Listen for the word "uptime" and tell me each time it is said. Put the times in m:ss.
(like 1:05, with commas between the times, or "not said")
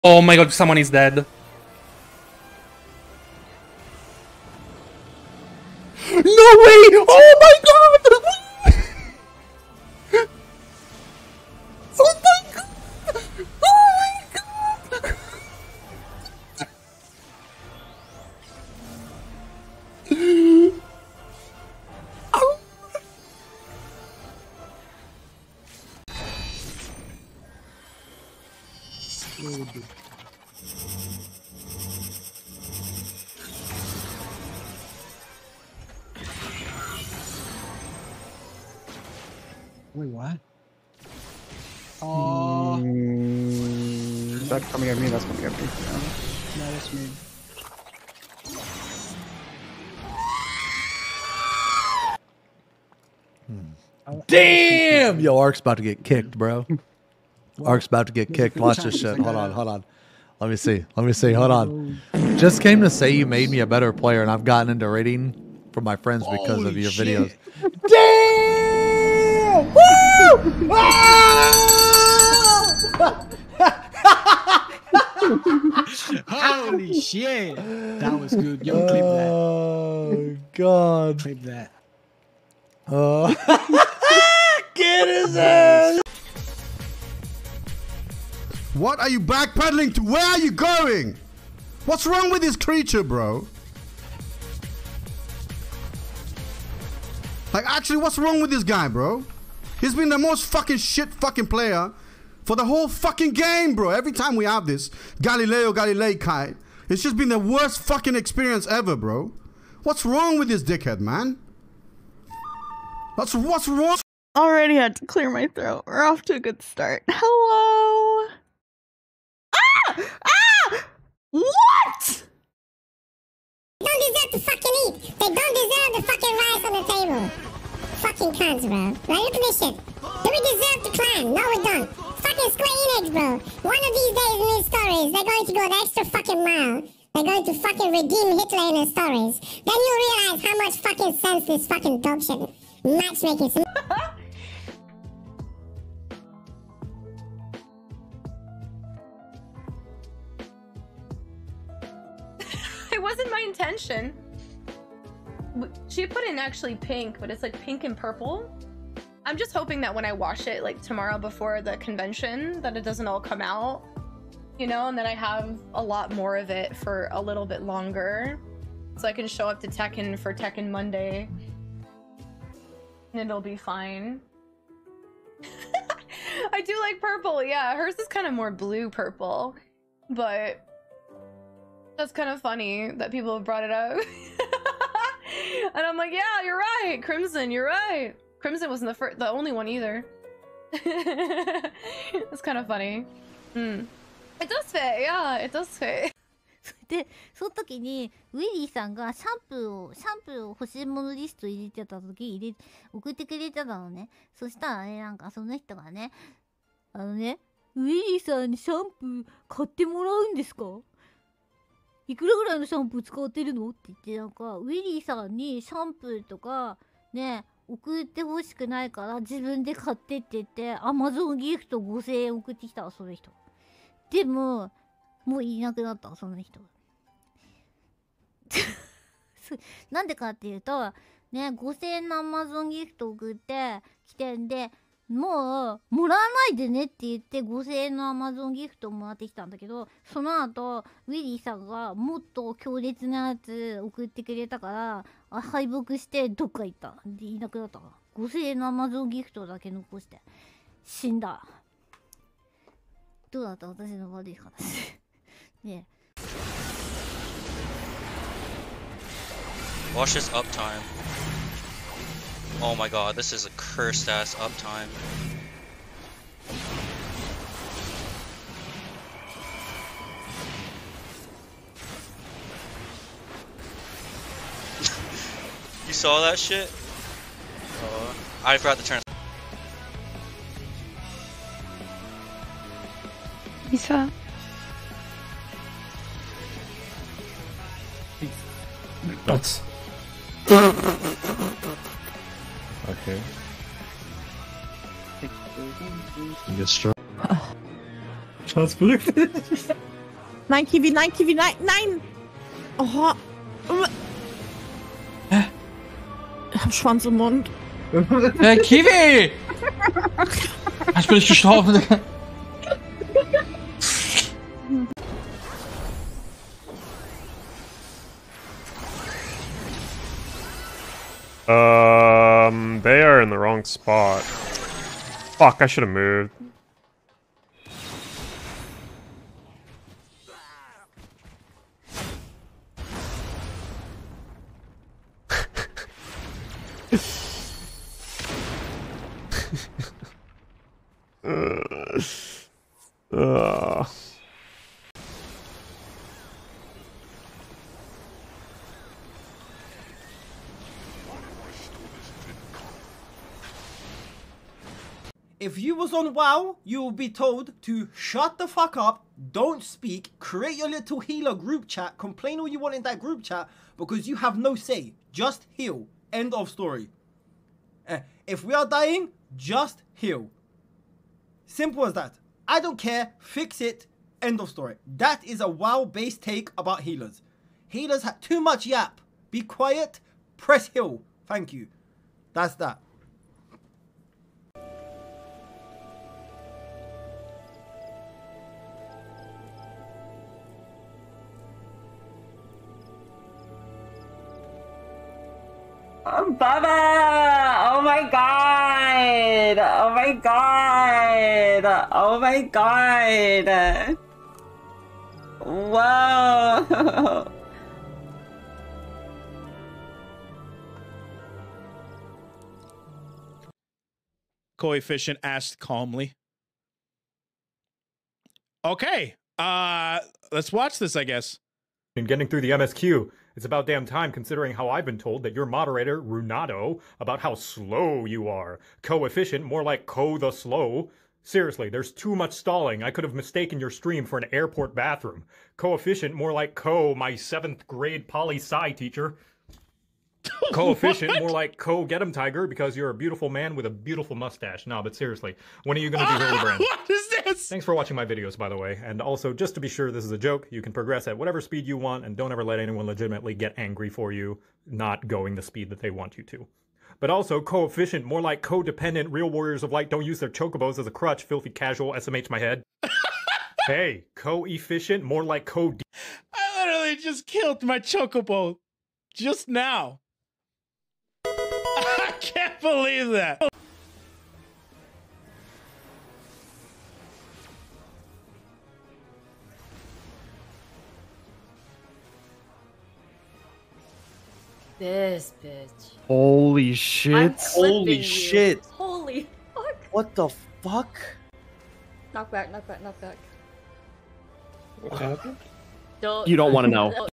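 4:20, 4:24.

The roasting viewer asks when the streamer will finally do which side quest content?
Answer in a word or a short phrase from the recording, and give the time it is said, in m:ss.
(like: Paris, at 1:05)
Hildebrand, at 7:26.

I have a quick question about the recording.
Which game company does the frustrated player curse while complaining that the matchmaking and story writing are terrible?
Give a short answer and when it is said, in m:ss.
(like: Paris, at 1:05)
Square Enix, at 2:12.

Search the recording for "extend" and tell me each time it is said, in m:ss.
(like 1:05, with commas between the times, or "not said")
not said.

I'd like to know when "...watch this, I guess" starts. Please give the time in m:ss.
7:00.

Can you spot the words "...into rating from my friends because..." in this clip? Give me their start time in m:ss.
1:04.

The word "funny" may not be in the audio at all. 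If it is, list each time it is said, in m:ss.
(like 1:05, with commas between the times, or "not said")
3:02, 3:12.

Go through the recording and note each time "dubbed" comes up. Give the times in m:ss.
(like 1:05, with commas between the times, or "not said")
not said.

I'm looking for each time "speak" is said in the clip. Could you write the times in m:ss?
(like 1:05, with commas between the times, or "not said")
5:59.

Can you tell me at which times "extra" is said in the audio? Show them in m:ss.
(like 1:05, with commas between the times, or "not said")
2:15.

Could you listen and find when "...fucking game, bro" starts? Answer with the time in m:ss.
1:42.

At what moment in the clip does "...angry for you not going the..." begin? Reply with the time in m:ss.
7:33.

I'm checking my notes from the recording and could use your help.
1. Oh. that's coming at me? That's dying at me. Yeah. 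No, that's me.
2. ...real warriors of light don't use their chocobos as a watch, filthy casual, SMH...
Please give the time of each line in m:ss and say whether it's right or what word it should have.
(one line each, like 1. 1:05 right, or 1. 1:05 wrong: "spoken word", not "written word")
1. 0:42 wrong: "coming", not "dying"
2. 7:39 wrong: "crutch", not "watch".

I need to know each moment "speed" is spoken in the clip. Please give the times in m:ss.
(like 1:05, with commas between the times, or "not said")
7:31, 7:35.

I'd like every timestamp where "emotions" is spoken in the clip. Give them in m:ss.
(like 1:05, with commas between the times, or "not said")
not said.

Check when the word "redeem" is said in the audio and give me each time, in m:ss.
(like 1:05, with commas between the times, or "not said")
2:17.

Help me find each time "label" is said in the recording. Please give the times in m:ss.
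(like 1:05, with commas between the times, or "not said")
not said.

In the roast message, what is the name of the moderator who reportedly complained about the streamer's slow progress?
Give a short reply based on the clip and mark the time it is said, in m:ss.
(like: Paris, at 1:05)
Runato, at 7:06.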